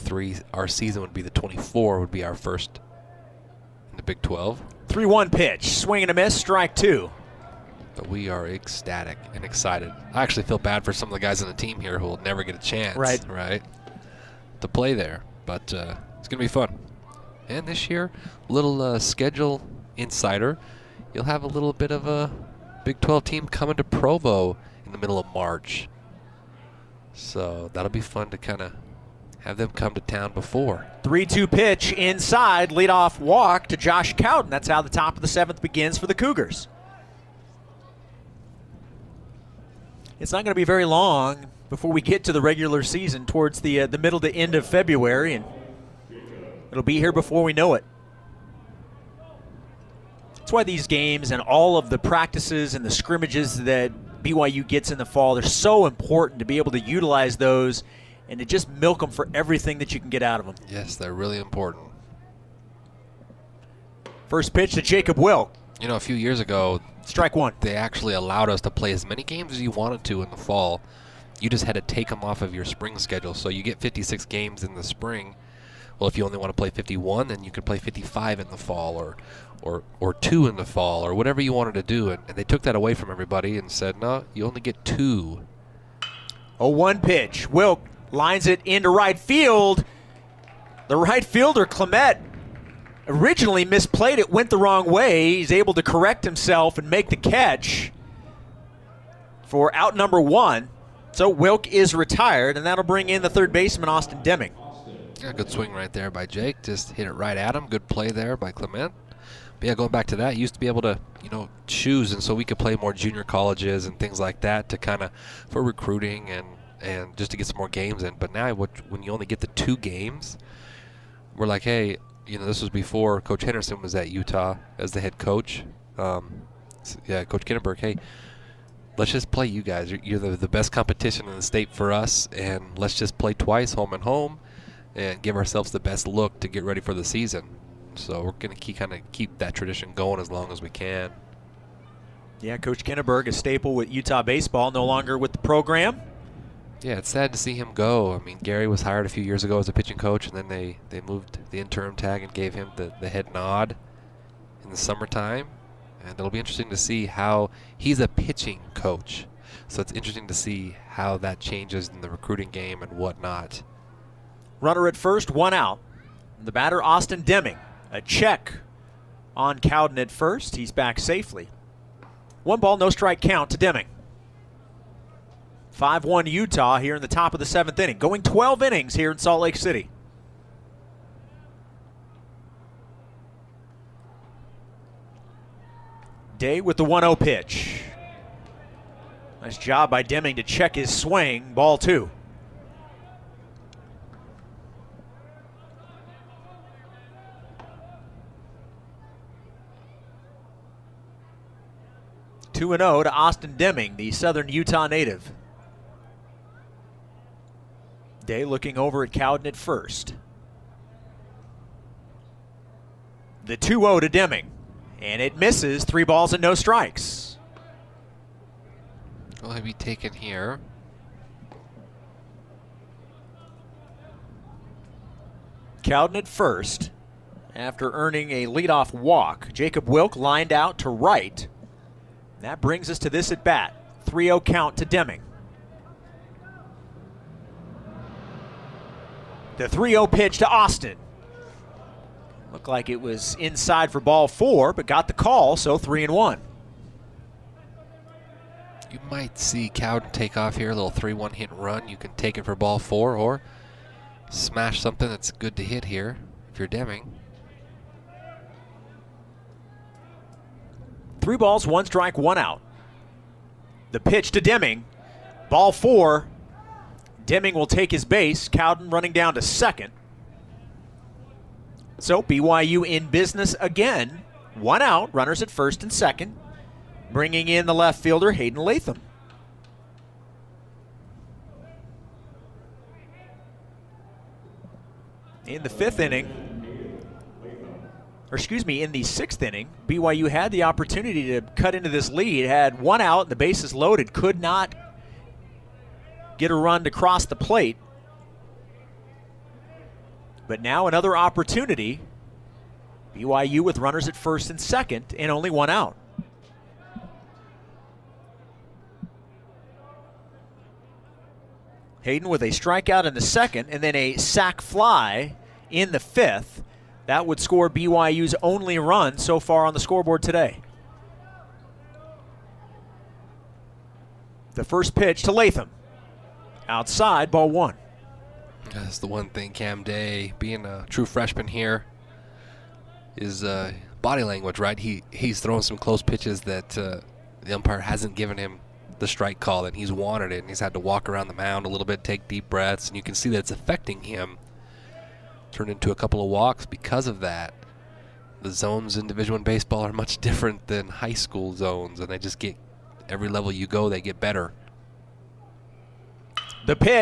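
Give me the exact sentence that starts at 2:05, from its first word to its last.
Um, yeah, Coach Kinneberg, hey, let's just play you guys.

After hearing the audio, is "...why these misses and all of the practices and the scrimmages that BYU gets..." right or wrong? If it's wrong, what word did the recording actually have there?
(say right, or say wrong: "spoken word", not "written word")
wrong: "games", not "misses".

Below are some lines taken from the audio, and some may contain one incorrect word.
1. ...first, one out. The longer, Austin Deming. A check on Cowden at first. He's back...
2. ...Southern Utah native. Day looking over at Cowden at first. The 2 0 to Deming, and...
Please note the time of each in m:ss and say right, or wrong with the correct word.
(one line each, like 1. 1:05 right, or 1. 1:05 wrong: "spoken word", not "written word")
1. 2:44 wrong: "batter", not "longer"
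2. 3:24 right.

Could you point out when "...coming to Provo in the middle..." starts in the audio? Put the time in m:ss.
0:23.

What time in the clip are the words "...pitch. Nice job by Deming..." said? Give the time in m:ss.
3:07.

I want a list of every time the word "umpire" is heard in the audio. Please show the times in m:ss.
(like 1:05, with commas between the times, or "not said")
5:37.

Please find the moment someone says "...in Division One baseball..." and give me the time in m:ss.
5:48.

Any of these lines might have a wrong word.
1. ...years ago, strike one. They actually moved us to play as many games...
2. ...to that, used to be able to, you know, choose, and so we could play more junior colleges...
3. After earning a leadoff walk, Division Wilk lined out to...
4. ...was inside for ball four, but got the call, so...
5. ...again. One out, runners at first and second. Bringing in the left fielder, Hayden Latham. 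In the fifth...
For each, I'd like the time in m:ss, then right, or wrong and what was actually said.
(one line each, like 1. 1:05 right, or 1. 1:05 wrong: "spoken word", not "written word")
1. 1:06 wrong: "allowed", not "moved"
2. 1:50 right
3. 3:47 wrong: "Jacob", not "Division"
4. 4:03 right
5. 4:33 right.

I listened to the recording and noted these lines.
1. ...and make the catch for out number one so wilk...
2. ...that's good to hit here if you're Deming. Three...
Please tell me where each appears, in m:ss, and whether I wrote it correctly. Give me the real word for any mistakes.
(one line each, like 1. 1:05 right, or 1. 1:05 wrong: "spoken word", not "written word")
1. 1:36 right
2. 4:15 right.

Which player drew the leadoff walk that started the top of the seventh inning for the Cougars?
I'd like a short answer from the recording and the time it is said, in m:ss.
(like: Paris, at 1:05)
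Josh Cowden, at 0:33.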